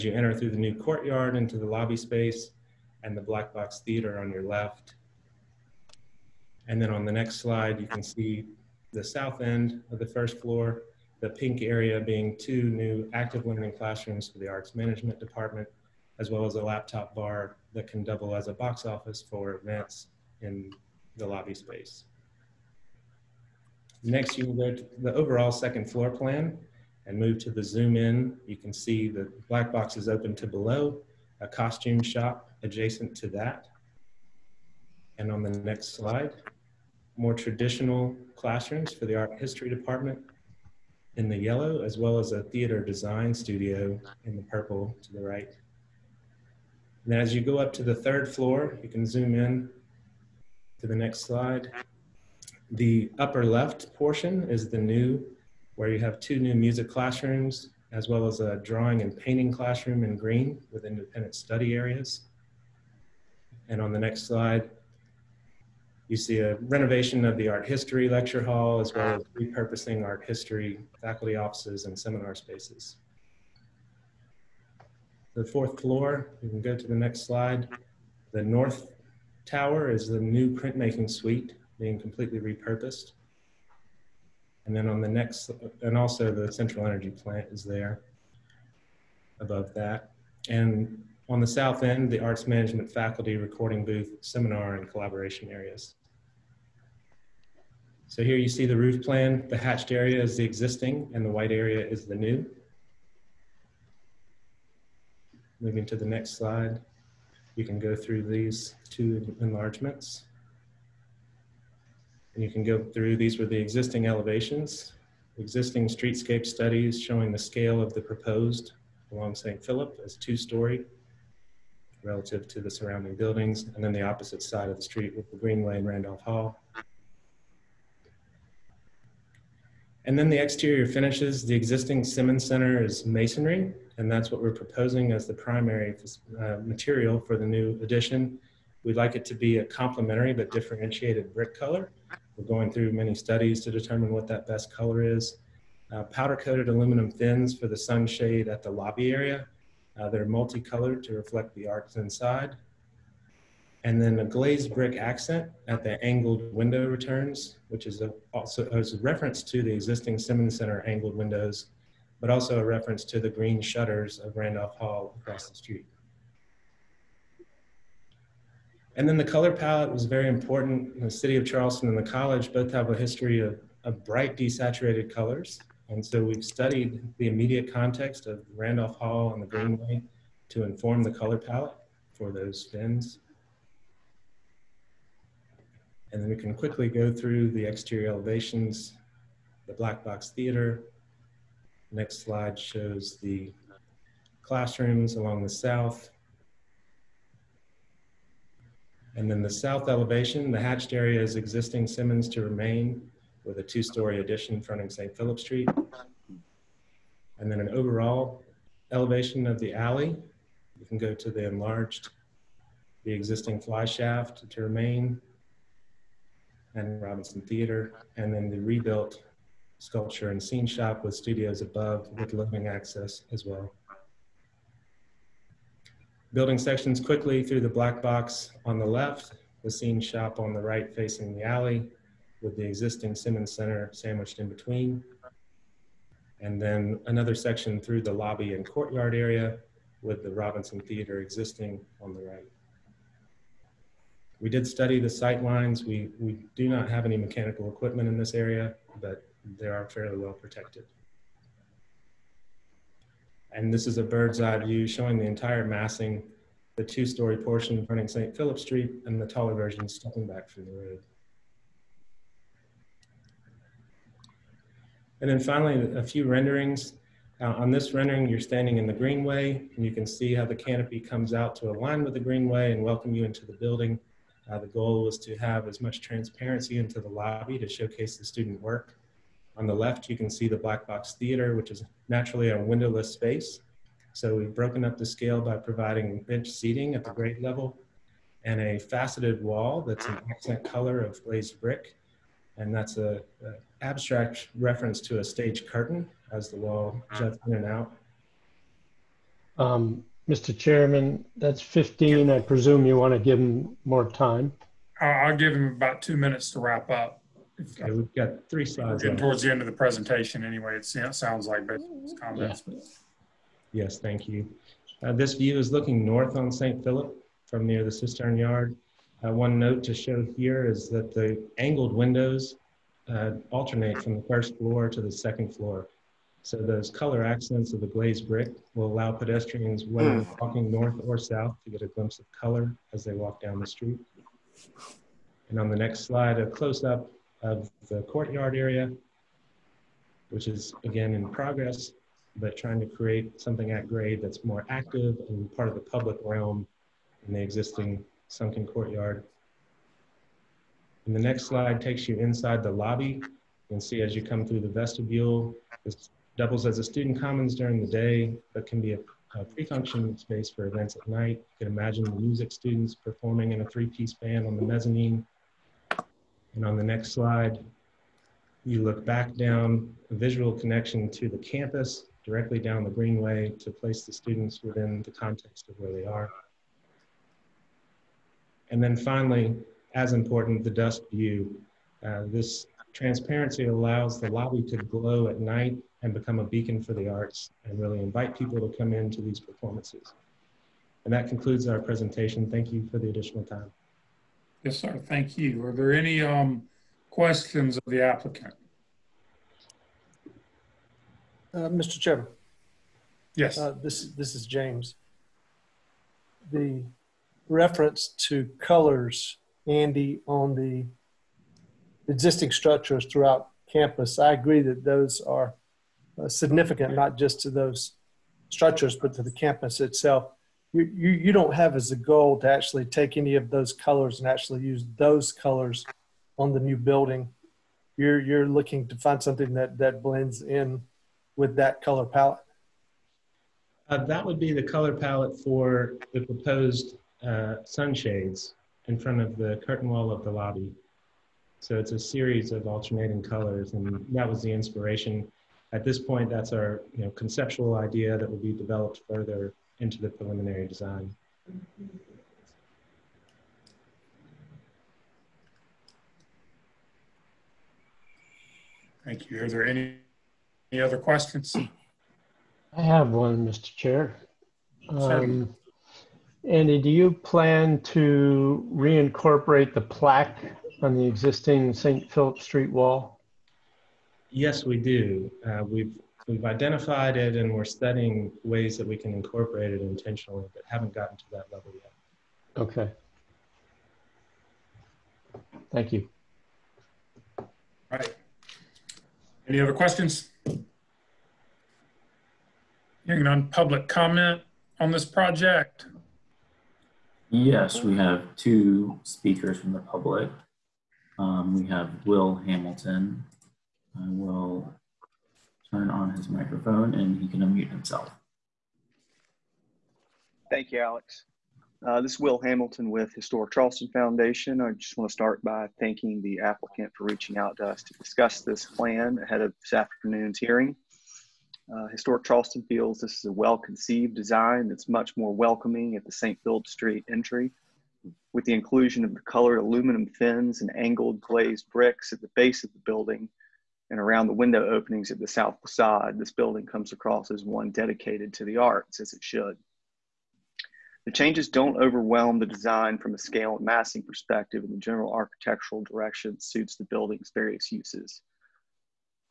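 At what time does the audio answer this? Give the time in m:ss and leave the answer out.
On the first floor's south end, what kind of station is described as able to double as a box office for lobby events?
0:16.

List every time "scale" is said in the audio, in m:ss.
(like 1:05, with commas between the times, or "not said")
1:57, 4:45, 9:03.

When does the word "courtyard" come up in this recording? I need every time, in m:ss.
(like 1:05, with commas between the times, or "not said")
0:00, 3:58, 5:38, 5:48.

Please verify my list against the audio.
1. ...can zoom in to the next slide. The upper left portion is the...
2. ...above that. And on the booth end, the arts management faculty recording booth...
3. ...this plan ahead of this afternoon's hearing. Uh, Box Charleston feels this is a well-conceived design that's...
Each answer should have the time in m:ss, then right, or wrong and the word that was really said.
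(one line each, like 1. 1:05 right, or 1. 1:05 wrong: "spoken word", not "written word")
1. 0:48 right
2. 1:29 wrong: "south", not "booth"
3. 8:38 wrong: "Historic", not "Box".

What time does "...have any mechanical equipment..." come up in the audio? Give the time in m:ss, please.
4:06.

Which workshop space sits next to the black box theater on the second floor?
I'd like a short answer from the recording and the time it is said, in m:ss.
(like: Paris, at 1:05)
costume shop, at 0:31.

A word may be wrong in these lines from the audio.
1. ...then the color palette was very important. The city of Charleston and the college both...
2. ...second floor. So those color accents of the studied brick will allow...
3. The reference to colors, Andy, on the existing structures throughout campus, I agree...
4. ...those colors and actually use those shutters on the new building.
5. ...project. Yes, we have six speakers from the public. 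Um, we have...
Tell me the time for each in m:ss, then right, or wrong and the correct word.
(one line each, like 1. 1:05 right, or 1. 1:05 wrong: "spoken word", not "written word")
1. 2:49 right
2. 5:25 wrong: "glazed", not "studied"
3. 6:46 right
4. 7:03 wrong: "colors", not "shutters"
5. 8:15 wrong: "two", not "six".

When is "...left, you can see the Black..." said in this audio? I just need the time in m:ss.
4:39.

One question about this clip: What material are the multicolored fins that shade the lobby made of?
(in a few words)
powder coated aluminum.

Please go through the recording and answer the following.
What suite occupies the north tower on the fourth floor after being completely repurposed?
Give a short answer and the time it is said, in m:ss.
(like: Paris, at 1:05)
printmaking suite, at 1:20.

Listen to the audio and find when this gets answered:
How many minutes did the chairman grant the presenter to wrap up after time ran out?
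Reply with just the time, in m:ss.
5:06.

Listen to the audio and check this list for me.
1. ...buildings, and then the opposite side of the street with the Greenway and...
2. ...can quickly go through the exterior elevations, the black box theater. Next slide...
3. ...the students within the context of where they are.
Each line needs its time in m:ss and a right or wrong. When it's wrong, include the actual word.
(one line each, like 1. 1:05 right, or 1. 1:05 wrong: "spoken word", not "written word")
1. 2:03 right
2. 3:06 right
3. 6:14 right.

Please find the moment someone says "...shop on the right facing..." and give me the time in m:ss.
3:50.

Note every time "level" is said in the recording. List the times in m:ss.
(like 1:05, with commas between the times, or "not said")
4:47, 8:01.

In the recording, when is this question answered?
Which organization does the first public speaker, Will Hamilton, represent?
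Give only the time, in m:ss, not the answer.
8:33.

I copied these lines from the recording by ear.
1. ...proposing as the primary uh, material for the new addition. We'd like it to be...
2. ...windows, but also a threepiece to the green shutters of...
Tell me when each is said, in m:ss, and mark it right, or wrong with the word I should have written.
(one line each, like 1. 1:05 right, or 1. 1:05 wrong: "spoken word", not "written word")
1. 2:14 right
2. 2:41 wrong: "reference", not "threepiece".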